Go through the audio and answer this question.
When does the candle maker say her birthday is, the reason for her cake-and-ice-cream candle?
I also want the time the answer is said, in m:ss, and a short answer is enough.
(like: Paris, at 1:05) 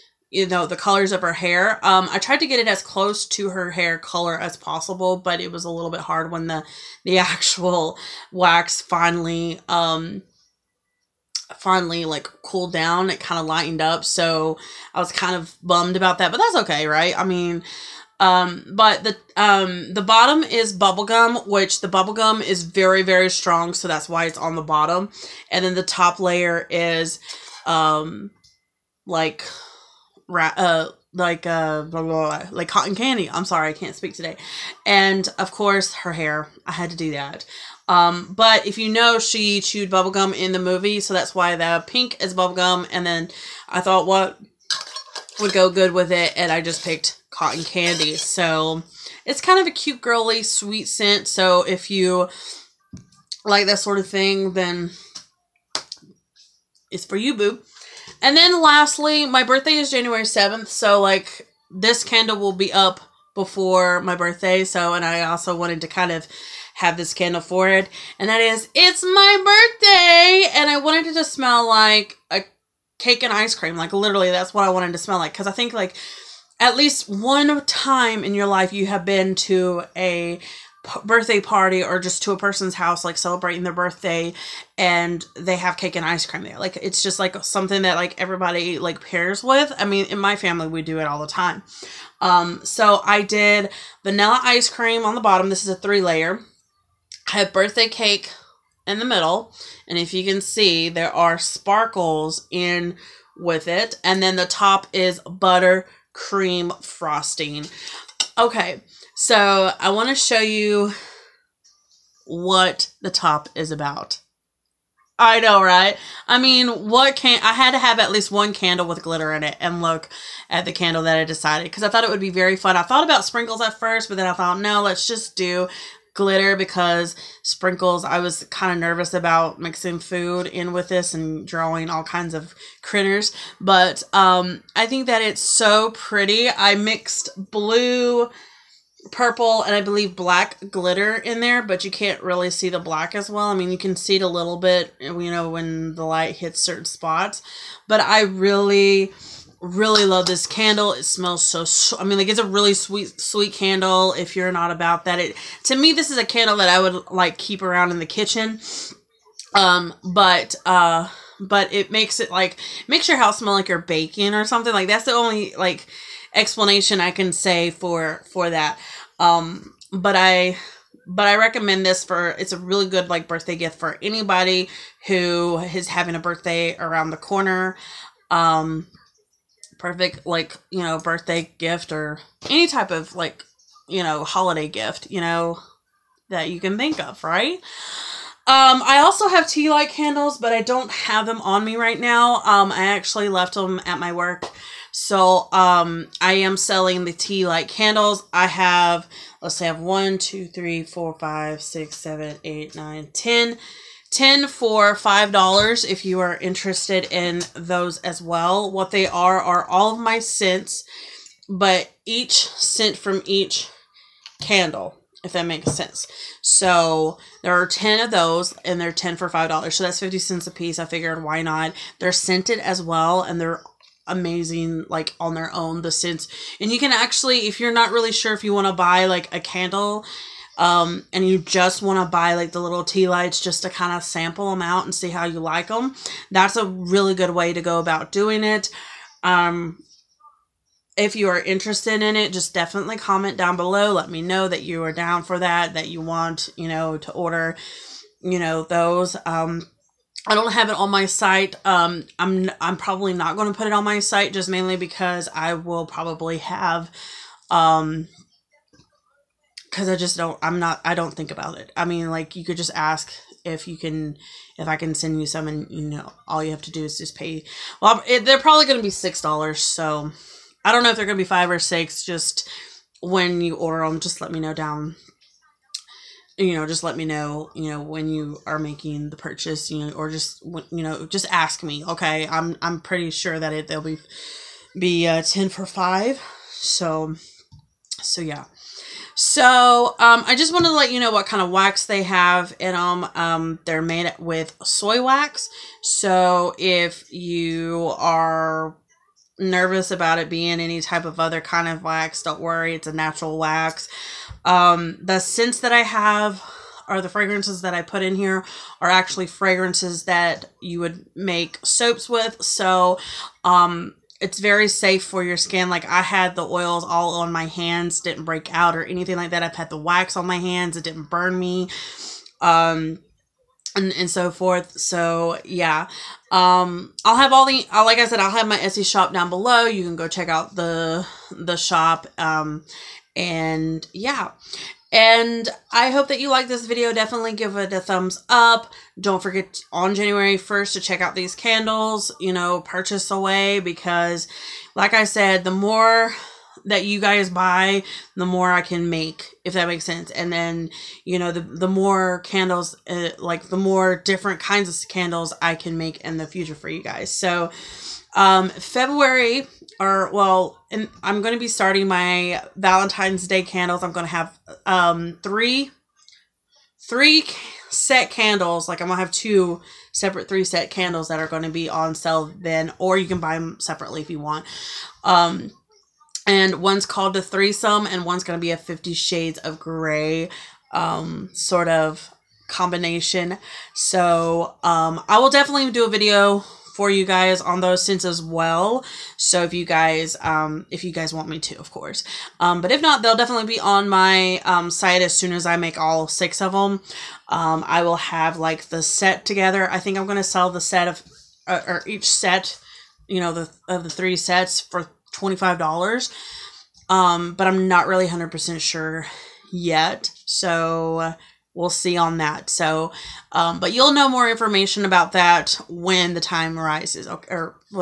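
January 7th, at 0:59.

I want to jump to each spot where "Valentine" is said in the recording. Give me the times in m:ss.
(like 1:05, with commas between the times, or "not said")
6:02.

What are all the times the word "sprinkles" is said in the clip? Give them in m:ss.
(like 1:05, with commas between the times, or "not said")
2:03, 2:07.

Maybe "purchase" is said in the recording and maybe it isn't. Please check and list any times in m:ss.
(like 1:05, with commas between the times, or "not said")
4:39, 5:42.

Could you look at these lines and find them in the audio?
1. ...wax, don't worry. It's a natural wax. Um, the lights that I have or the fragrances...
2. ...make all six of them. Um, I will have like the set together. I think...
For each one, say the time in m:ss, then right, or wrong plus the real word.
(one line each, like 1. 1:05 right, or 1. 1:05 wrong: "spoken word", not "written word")
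1. 5:01 wrong: "scents", not "lights"
2. 6:35 right.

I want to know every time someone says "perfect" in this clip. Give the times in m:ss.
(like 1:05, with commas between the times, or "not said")
2:59.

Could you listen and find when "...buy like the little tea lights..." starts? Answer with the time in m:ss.
3:52.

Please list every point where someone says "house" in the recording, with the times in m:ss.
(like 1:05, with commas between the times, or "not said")
1:22, 2:43.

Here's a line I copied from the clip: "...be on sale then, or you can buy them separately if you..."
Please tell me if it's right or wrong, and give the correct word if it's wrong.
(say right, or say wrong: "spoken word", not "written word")
right.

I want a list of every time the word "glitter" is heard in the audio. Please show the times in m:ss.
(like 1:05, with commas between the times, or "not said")
1:59, 2:06, 2:20.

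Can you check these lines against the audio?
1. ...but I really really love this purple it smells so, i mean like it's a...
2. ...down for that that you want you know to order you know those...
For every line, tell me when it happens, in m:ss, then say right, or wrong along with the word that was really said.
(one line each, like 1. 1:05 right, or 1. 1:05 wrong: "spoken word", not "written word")
1. 2:27 wrong: "candle", not "purple"
2. 4:04 right.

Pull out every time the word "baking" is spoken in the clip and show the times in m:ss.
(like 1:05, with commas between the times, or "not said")
2:43.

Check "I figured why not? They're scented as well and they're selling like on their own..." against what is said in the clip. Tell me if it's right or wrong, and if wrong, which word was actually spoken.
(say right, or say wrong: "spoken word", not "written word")
wrong: "amazing", not "selling".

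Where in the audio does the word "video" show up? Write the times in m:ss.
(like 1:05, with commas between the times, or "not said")
5:36, 6:25.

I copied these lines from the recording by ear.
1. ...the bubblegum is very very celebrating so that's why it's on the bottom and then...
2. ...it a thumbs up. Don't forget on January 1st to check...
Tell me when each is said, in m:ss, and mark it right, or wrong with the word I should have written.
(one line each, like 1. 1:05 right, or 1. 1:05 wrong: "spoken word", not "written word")
1. 0:21 wrong: "strong", not "celebrating"
2. 5:37 right.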